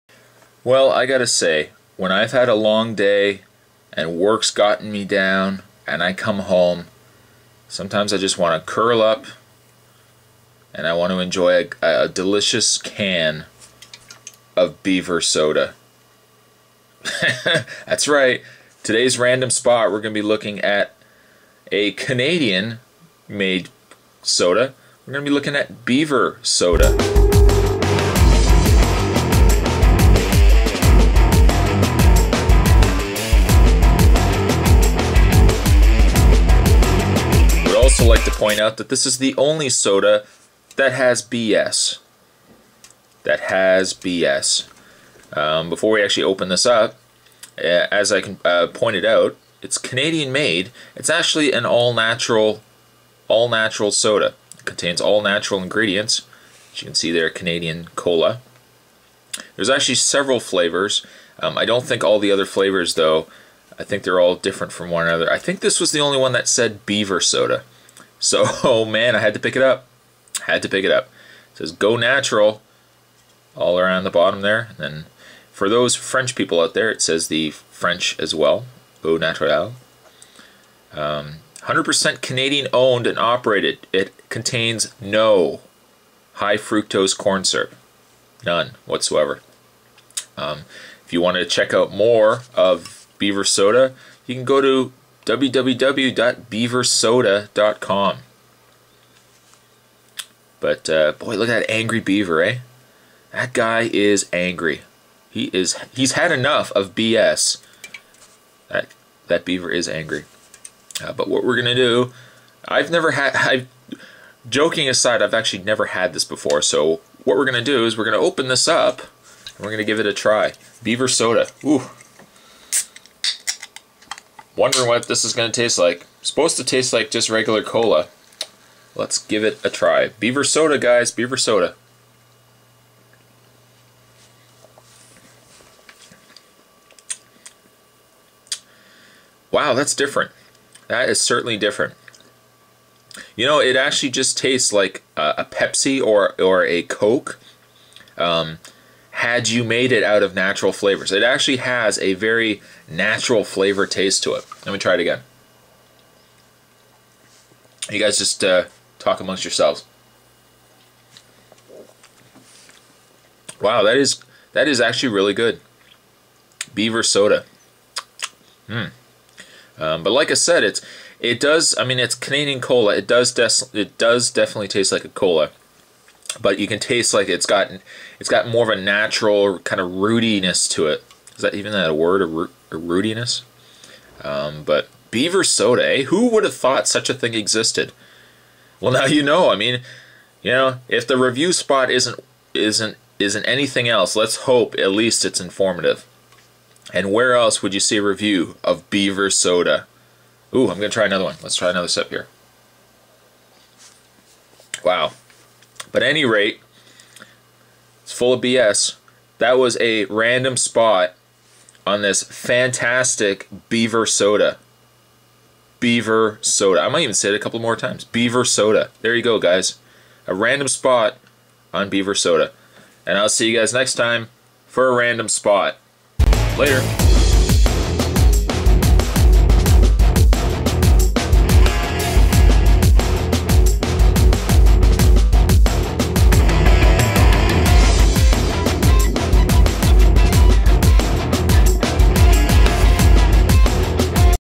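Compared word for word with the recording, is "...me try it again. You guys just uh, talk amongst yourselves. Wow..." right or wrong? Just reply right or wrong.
right.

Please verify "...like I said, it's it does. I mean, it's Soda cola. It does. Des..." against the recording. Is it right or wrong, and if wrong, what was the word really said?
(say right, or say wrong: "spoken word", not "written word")
wrong: "Canadian", not "Soda".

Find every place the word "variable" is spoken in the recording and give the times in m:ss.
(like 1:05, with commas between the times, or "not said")
not said.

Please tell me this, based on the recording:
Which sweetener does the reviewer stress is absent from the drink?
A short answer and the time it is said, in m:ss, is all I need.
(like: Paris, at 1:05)
High fructose corn syrup, at 1:26.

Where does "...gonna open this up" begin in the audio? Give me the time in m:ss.
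1:58.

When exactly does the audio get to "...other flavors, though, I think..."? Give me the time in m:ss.
1:02.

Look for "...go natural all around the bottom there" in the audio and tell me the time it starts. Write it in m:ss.
1:11.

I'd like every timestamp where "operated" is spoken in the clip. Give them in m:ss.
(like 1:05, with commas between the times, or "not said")
1:23.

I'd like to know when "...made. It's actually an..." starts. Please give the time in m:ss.
0:50.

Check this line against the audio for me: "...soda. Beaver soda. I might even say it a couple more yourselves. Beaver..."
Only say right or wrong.
wrong.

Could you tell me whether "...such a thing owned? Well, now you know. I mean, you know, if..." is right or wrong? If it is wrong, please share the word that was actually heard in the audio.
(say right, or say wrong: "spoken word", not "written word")
wrong: "existed", not "owned".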